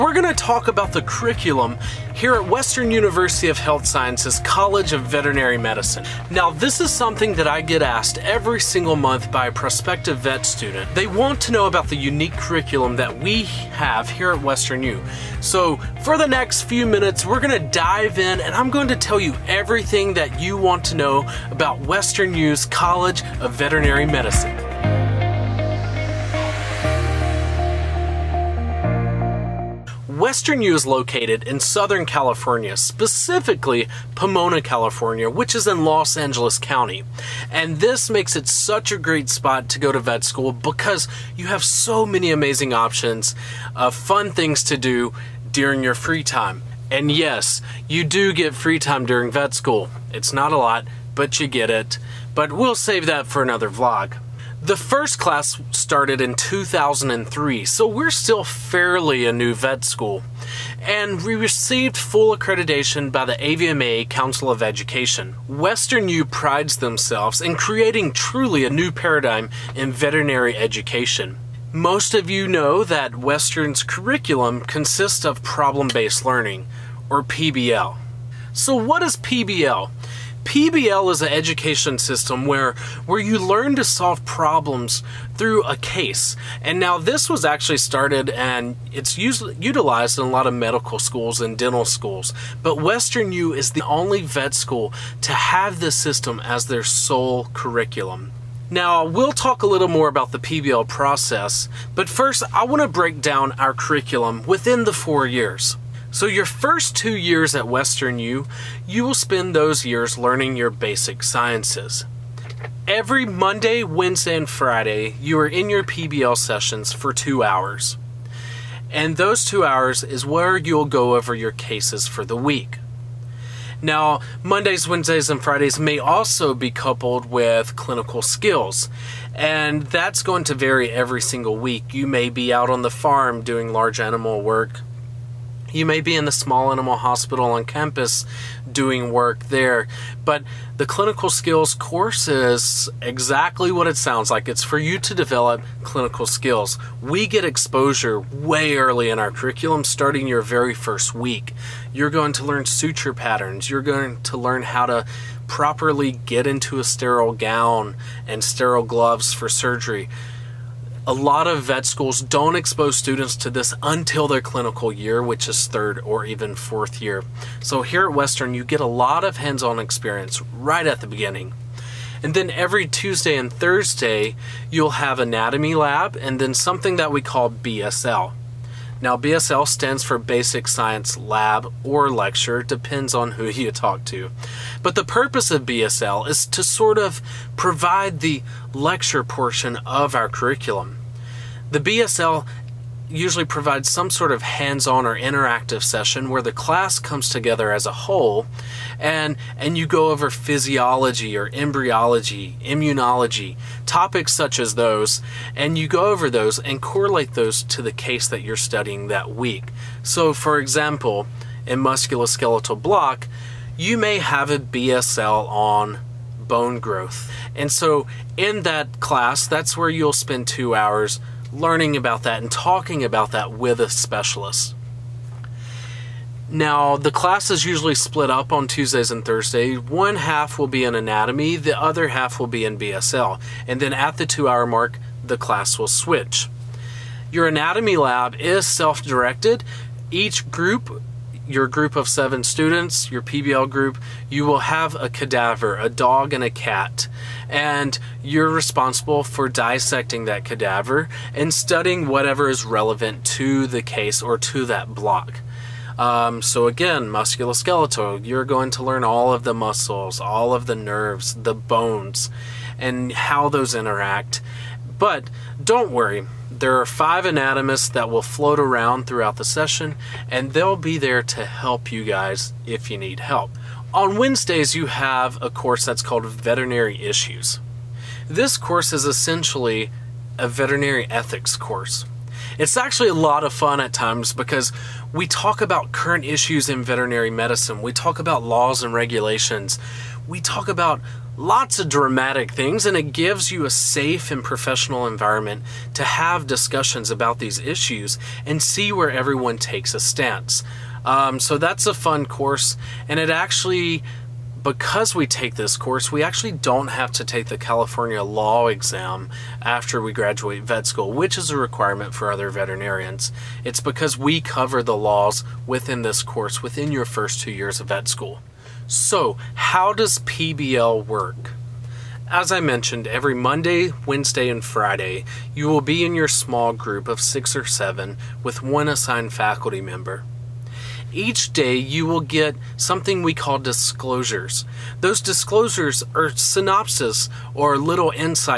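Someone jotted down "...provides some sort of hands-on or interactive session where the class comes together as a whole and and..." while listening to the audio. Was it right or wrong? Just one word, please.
right.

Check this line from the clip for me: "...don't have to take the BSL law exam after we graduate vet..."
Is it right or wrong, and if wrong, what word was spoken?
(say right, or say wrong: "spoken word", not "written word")
wrong: "California", not "BSL".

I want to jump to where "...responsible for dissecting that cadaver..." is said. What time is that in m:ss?
4:08.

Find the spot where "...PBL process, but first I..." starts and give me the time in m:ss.
1:40.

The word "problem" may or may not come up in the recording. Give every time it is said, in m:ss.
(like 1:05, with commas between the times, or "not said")
1:15, 1:24.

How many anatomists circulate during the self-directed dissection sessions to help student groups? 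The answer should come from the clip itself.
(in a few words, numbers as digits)
5.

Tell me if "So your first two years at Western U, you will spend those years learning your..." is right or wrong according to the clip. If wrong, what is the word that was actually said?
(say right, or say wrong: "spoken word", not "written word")
right.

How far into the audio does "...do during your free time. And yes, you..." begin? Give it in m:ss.
0:44.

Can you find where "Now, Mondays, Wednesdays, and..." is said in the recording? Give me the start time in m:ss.
2:03.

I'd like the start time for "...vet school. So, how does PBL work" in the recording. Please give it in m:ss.
5:17.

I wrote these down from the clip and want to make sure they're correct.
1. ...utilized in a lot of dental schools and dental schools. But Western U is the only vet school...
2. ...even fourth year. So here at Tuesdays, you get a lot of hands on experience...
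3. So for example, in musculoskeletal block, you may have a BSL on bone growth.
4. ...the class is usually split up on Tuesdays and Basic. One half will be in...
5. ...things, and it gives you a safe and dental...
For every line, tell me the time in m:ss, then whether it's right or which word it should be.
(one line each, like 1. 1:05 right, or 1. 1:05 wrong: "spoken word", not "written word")
1. 1:29 wrong: "medical", not "dental"
2. 2:46 wrong: "Western", not "Tuesdays"
3. 3:30 right
4. 3:46 wrong: "Thursdays", not "Basic"
5. 4:52 wrong: "professional", not "dental".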